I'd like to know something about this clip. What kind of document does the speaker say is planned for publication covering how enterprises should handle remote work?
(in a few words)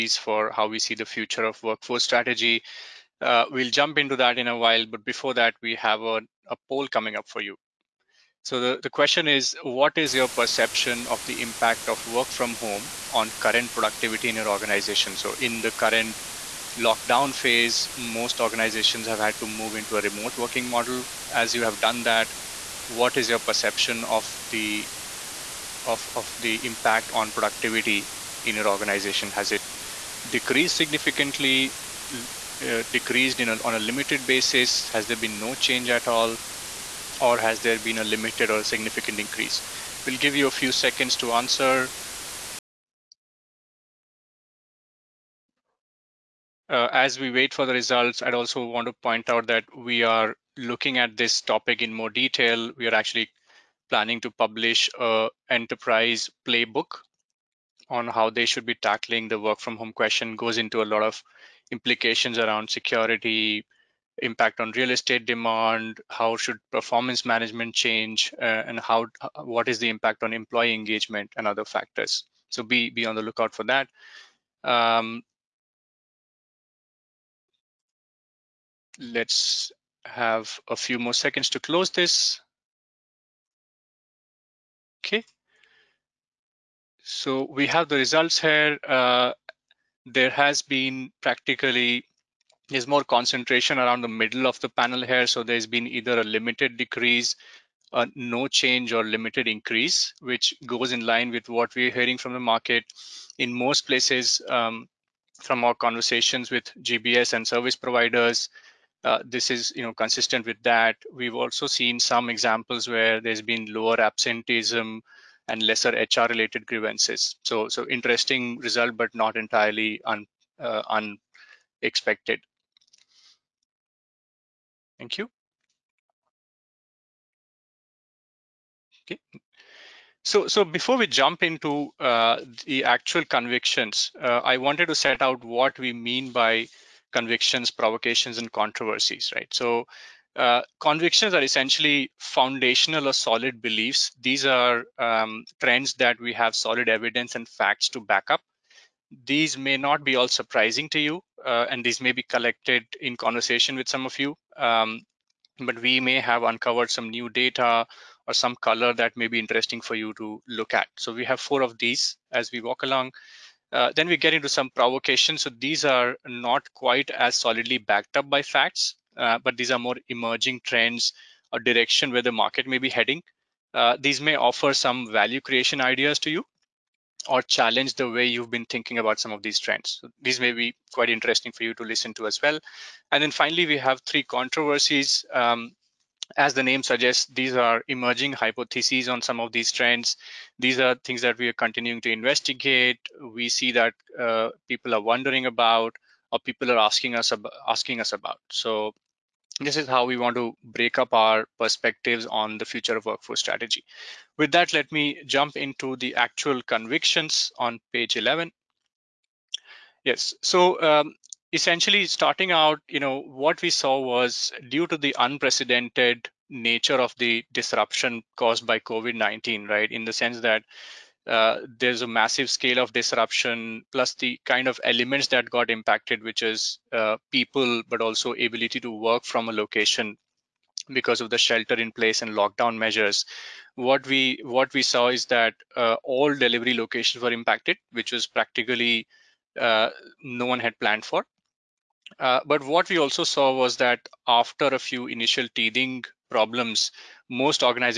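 enterprise playbook.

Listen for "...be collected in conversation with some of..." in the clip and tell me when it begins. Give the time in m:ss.
2:32.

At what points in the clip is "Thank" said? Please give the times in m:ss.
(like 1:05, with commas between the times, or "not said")
2:05.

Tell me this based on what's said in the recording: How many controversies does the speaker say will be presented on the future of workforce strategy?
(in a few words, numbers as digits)
3.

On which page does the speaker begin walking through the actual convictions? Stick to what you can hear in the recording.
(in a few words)
Page 11.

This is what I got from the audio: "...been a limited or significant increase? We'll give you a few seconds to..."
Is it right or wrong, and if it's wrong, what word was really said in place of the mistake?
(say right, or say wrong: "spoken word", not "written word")
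right.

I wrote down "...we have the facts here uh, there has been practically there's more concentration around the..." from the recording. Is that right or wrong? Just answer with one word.
wrong.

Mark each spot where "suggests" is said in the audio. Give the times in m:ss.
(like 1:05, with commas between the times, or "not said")
3:06.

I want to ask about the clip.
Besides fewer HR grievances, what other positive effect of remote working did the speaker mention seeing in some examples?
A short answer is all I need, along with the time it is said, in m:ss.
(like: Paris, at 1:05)
lower absenteeism, at 1:53.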